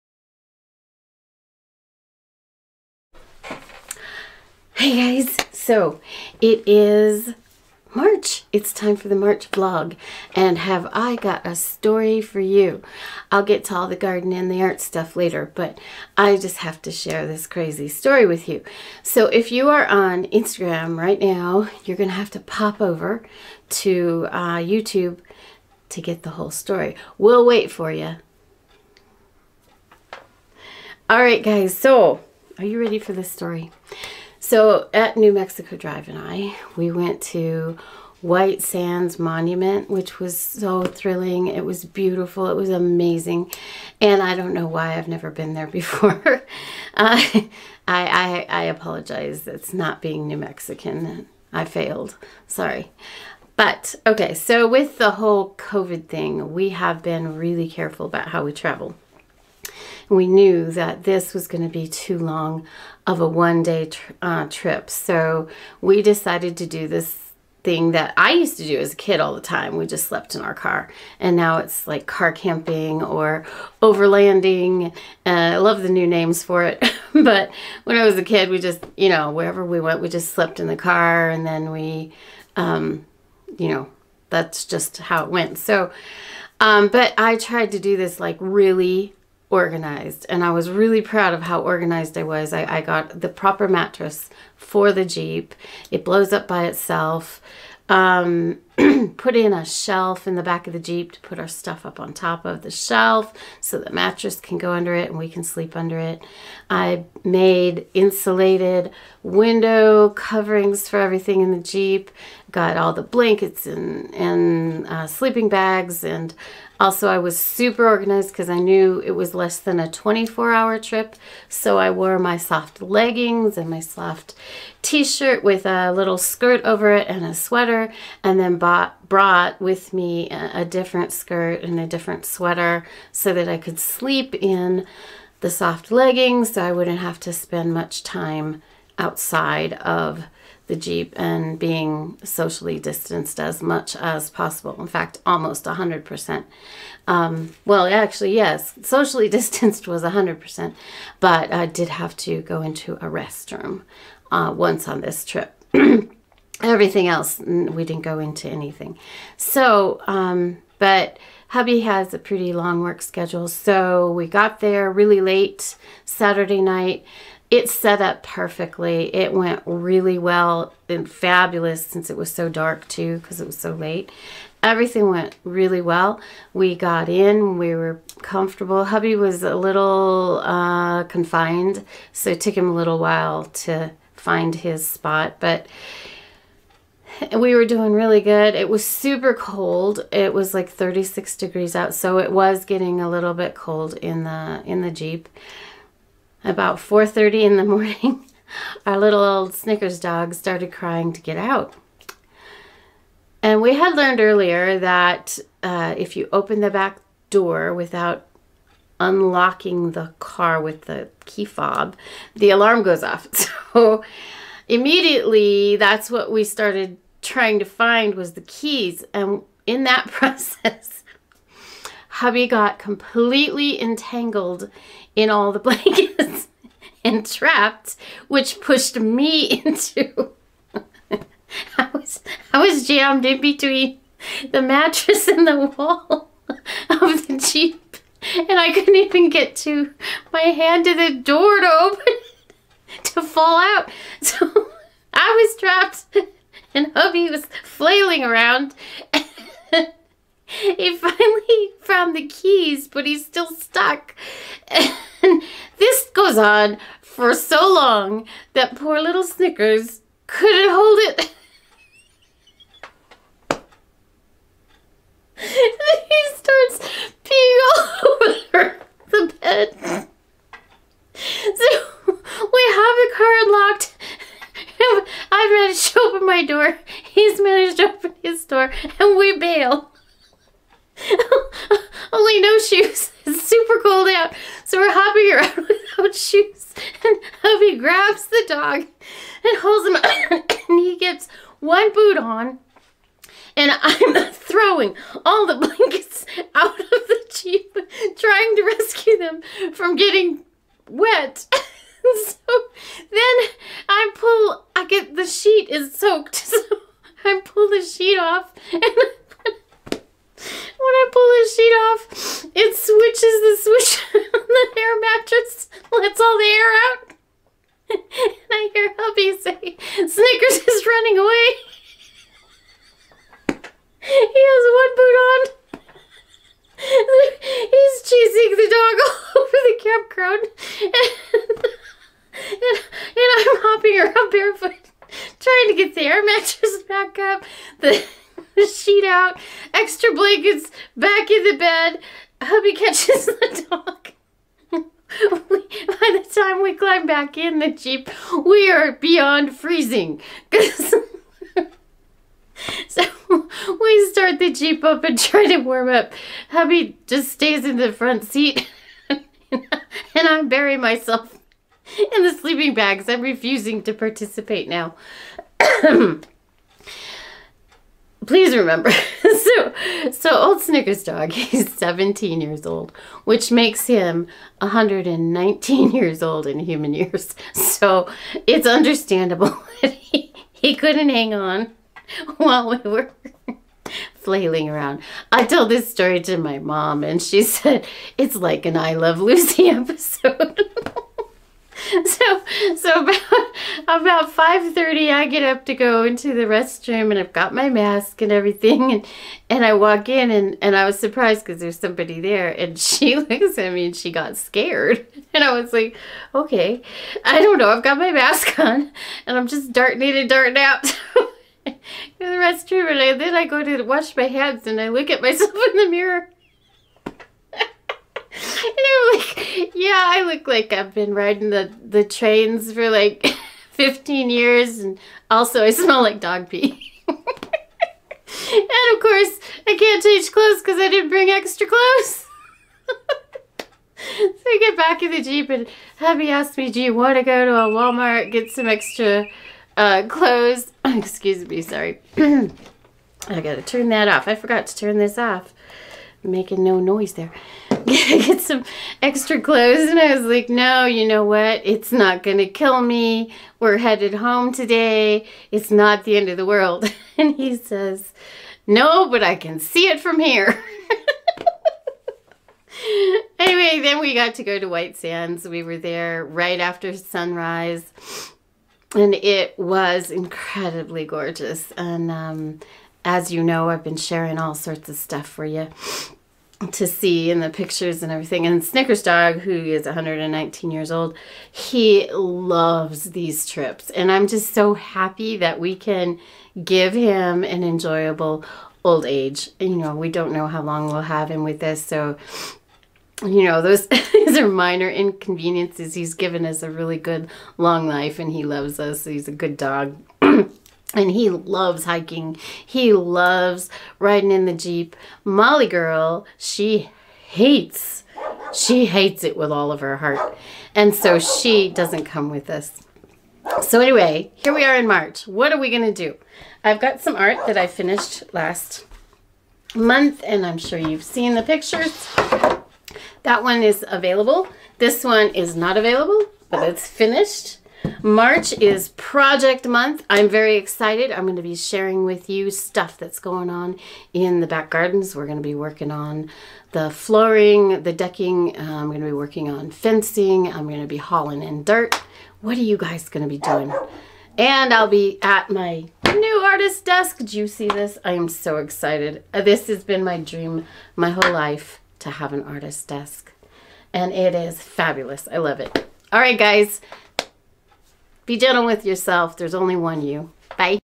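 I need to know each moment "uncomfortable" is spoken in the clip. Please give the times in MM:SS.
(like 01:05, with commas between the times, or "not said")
not said.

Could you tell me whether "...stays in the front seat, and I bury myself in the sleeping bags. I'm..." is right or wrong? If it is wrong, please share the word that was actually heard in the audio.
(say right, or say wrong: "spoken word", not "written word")
right.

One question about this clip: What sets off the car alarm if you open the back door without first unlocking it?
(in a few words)
key fob.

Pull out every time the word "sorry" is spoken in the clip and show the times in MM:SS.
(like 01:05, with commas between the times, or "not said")
00:52, 07:21.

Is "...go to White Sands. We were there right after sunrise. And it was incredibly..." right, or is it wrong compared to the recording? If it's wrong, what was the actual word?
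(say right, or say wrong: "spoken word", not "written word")
right.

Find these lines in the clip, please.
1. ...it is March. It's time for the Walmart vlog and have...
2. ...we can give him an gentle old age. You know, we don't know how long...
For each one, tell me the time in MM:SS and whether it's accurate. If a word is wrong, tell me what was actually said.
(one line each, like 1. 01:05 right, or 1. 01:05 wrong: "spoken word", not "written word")
1. 00:06 wrong: "March", not "Walmart"
2. 08:05 wrong: "enjoyable", not "gentle".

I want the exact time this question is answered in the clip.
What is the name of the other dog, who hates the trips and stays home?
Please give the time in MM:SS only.
08:25.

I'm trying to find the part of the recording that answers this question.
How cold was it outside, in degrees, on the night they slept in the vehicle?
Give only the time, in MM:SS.
03:10.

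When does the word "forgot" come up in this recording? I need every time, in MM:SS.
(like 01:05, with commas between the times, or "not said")
07:24.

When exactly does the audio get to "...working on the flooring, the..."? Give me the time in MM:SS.
08:55.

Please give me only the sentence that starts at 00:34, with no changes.
So at New Mexico Drive and I, we went to White Sands Monument, which was so thrilling.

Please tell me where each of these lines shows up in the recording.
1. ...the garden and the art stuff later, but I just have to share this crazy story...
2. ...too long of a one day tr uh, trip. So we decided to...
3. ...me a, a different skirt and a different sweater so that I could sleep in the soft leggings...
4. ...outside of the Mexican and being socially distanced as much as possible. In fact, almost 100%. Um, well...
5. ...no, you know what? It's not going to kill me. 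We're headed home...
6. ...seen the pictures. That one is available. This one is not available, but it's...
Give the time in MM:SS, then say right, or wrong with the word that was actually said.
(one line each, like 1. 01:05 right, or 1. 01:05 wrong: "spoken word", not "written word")
1. 00:13 right
2. 01:01 right
3. 02:09 right
4. 02:18 wrong: "Jeep", not "Mexican"
5. 07:30 right
6. 08:41 right.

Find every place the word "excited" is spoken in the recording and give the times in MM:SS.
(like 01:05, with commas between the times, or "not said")
08:50, 09:08.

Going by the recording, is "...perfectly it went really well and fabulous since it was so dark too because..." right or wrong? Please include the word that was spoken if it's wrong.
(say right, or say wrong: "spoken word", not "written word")
right.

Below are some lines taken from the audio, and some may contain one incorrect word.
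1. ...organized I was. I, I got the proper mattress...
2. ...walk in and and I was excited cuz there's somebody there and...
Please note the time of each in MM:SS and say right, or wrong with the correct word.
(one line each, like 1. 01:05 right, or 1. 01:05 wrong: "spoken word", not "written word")
1. 01:31 right
2. 06:39 wrong: "surprised", not "excited".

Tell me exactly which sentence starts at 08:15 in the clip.
He's given us a really good long life and he loves us.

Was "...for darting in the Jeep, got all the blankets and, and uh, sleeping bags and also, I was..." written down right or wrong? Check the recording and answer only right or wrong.
wrong.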